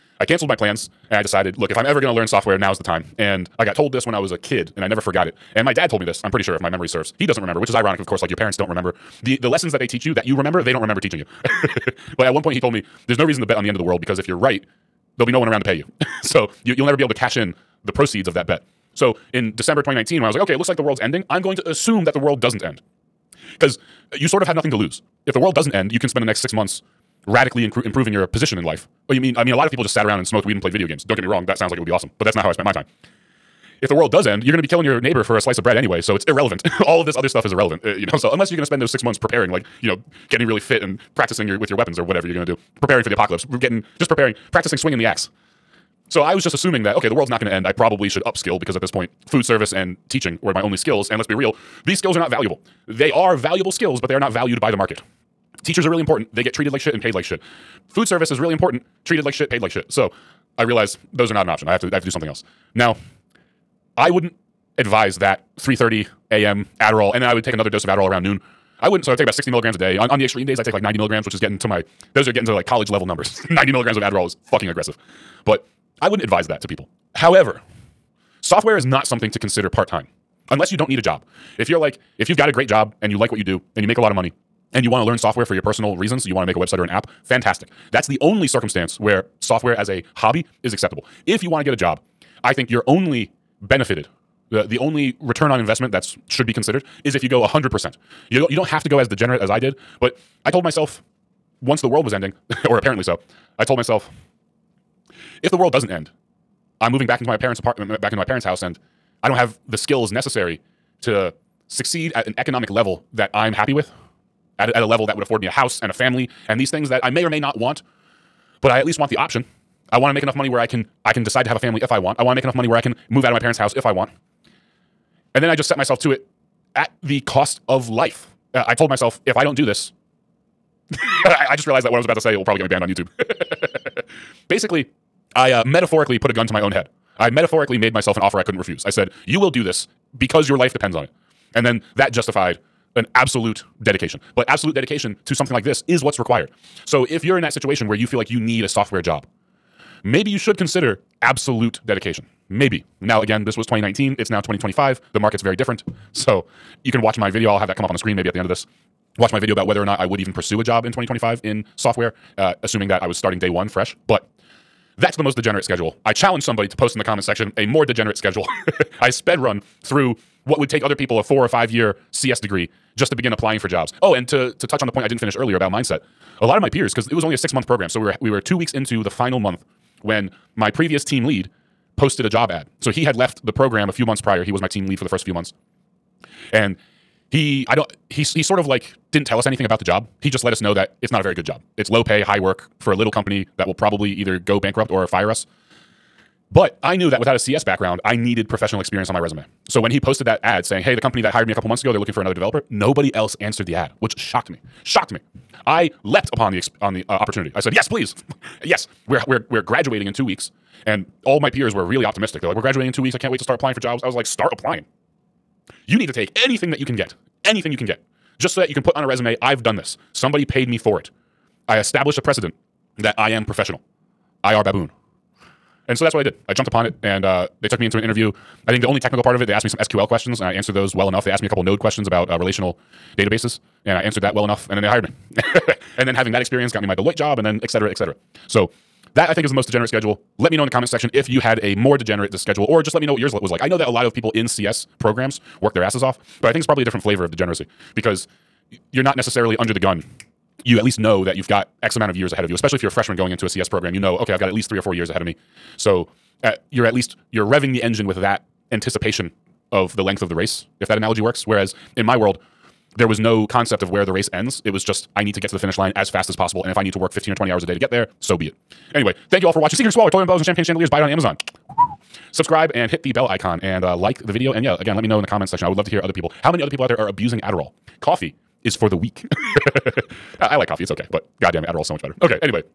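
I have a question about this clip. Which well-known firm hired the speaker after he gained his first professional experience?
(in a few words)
Deloitte.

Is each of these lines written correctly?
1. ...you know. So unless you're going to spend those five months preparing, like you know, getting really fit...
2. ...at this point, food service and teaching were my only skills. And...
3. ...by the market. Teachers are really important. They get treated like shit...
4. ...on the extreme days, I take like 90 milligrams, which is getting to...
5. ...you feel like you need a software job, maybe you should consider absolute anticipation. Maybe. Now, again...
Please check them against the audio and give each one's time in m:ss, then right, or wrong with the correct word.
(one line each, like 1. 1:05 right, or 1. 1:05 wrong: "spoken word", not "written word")
1. 0:37 wrong: "six", not "five"
2. 0:48 right
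3. 0:54 right
4. 1:10 right
5. 2:27 wrong: "dedication", not "anticipation".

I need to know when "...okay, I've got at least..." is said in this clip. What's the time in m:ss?
4:14.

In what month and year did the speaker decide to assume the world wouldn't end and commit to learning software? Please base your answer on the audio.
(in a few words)
December 2019.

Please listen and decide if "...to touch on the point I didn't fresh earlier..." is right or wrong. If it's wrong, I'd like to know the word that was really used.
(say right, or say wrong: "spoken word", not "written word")
wrong: "finish", not "fresh".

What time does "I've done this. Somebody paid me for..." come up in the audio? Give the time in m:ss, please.
3:39.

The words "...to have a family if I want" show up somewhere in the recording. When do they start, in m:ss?
2:01.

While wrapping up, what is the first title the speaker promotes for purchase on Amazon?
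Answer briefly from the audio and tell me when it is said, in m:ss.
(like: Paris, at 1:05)
Seeking Squalor, at 4:29.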